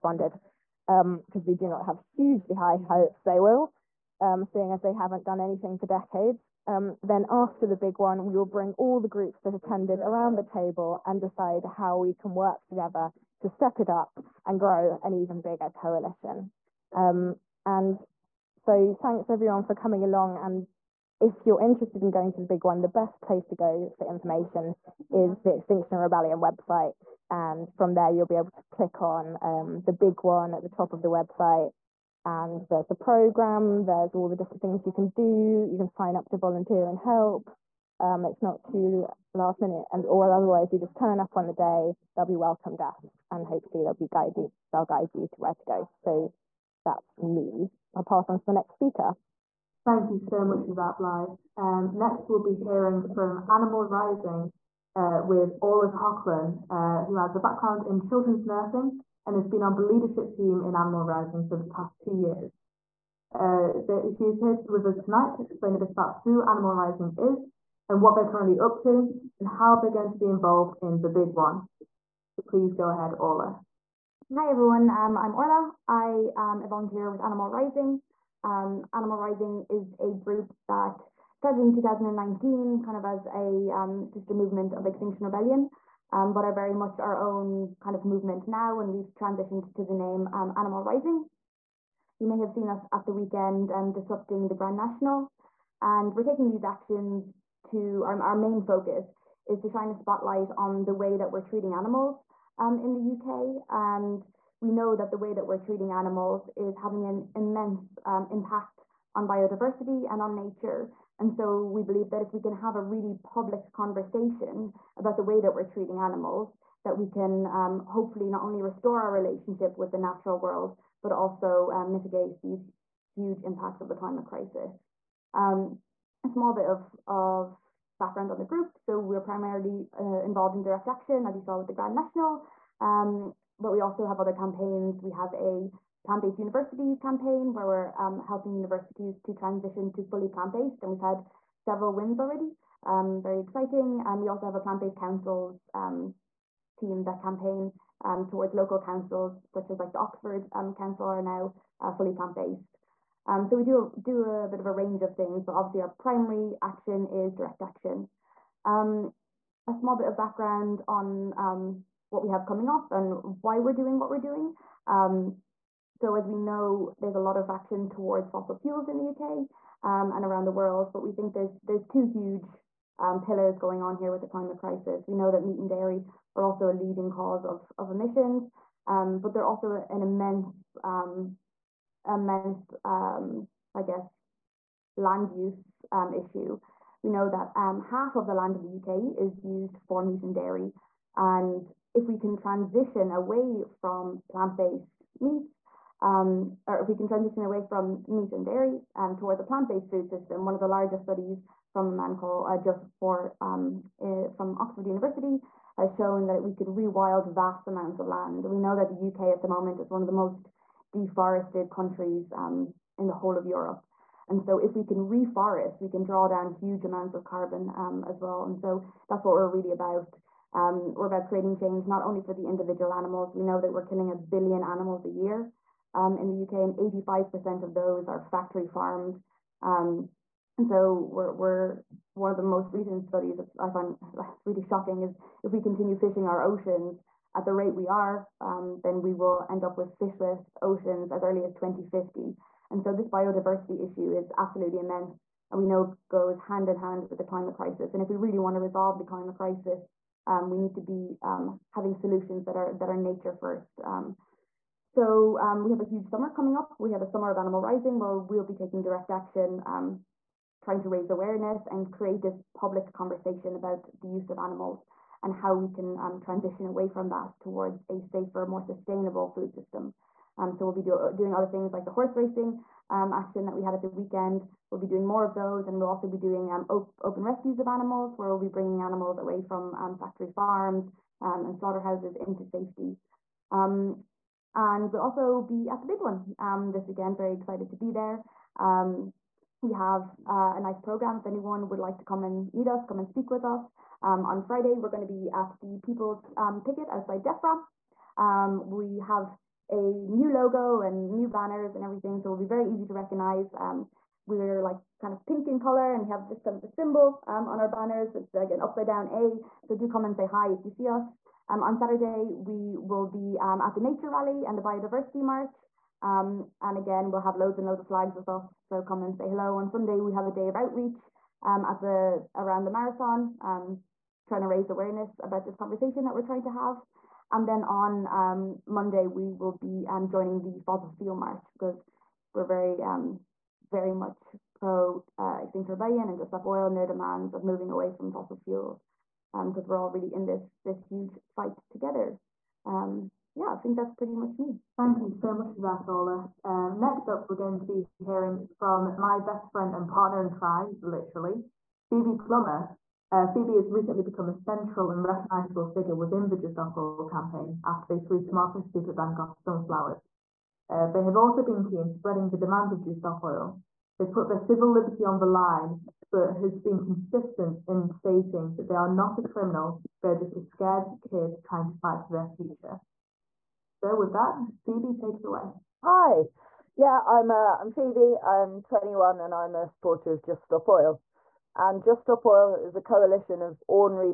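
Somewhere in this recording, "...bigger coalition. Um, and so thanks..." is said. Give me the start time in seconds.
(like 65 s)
15 s.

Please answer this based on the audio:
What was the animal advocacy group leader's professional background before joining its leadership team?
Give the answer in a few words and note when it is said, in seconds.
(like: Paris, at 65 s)
Children's nursing, at 57 s.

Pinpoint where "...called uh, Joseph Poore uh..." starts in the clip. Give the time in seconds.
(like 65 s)
202 s.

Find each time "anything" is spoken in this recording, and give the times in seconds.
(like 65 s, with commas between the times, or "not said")
5 s.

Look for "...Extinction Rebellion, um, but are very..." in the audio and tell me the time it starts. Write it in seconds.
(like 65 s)
84 s.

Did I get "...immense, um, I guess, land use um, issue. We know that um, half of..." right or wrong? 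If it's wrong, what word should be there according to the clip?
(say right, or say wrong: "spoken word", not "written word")
right.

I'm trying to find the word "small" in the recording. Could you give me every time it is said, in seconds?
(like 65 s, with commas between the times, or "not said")
126 s, 159 s.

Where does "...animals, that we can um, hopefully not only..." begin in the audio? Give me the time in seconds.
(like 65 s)
115 s.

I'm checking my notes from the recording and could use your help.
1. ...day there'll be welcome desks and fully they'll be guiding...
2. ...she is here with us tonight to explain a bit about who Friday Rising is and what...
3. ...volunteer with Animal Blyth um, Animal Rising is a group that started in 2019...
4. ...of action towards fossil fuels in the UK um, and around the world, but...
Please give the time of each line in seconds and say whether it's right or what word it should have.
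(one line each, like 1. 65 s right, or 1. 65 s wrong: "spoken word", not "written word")
1. 41 s wrong: "hopefully", not "fully"
2. 64 s wrong: "Animal", not "Friday"
3. 76 s wrong: "Rising", not "Blyth"
4. 167 s right.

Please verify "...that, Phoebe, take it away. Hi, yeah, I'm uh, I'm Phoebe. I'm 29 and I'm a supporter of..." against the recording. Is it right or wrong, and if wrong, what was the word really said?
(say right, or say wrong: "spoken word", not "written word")
wrong: "21", not "29".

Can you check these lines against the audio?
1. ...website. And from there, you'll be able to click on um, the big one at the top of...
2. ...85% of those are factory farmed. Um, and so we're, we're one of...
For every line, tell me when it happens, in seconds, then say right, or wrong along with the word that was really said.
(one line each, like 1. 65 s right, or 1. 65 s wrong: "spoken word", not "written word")
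1. 26 s right
2. 226 s right.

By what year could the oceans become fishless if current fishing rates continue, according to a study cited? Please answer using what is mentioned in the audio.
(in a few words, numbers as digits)
2050.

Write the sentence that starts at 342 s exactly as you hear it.
Um, yeah, I think that's pretty much me.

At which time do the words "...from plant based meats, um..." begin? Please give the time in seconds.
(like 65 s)
193 s.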